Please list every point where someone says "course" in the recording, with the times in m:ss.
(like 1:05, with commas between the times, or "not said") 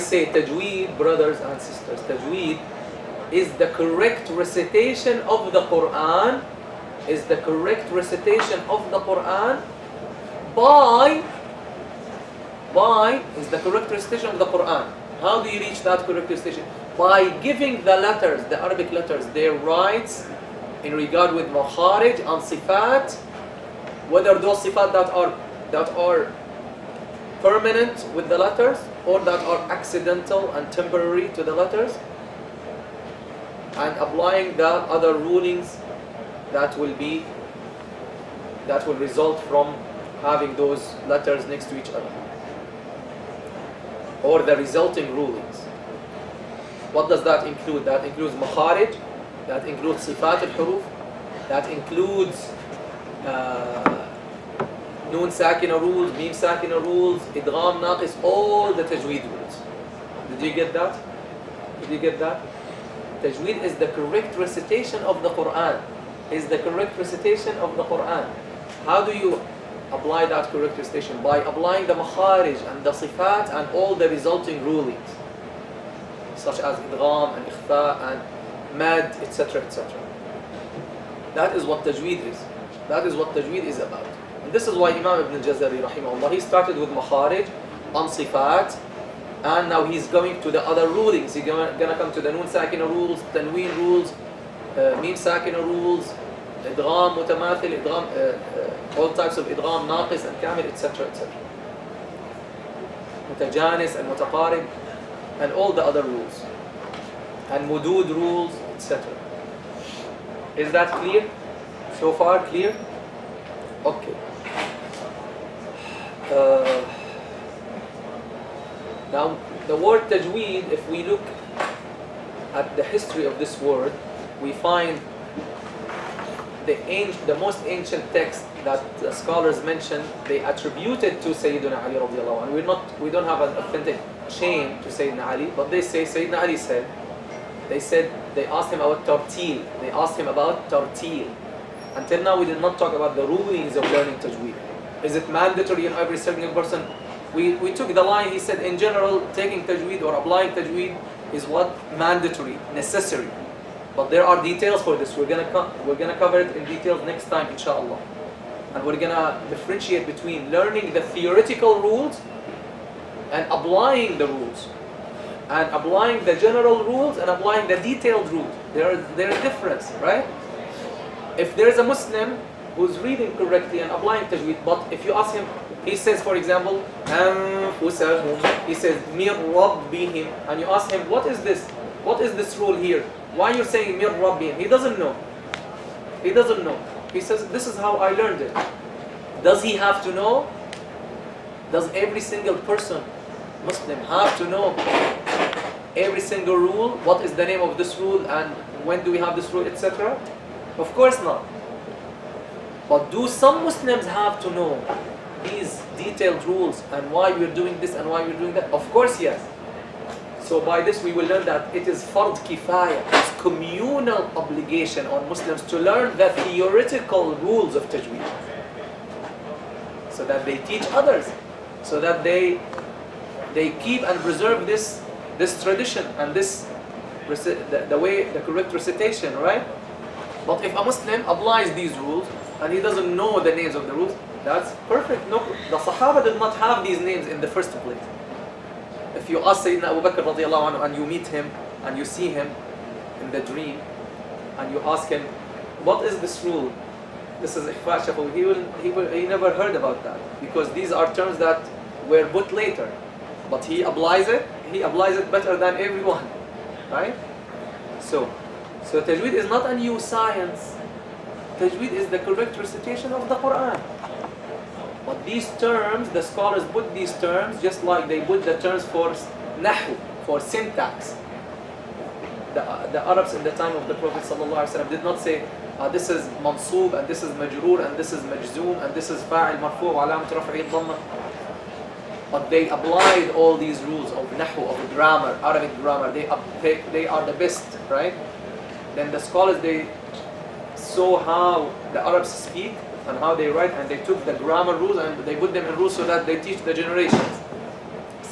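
3:20, 3:28.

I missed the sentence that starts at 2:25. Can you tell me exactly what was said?
Is it mandatory in every single person?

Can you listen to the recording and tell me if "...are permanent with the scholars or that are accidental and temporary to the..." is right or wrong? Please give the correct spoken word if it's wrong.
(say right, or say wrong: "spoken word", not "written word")
wrong: "letters", not "scholars".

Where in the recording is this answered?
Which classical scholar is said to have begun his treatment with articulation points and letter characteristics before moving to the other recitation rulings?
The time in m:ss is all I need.
1:24.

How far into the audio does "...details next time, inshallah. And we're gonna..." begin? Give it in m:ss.
2:36.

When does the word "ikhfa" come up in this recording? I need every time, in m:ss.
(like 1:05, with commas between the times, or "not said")
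1:17, 4:07.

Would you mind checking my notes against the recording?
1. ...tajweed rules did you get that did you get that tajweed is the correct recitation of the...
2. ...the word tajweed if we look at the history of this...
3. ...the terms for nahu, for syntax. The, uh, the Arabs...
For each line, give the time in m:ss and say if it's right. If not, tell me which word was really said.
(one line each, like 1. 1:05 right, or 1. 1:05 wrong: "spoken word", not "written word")
1. 0:58 right
2. 1:59 right
3. 4:28 right.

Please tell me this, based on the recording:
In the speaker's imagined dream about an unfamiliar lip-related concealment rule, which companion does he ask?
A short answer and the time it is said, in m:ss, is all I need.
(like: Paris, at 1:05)
Abu Bakr, at 3:59.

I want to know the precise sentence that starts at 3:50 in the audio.
But if a Muslim applies these rules and he doesn't know the names of the rules, that's perfect.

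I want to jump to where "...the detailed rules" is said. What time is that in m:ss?
2:47.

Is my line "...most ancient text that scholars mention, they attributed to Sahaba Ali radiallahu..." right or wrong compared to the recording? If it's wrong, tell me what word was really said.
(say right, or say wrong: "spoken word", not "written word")
wrong: "Sayyidina", not "Sahaba".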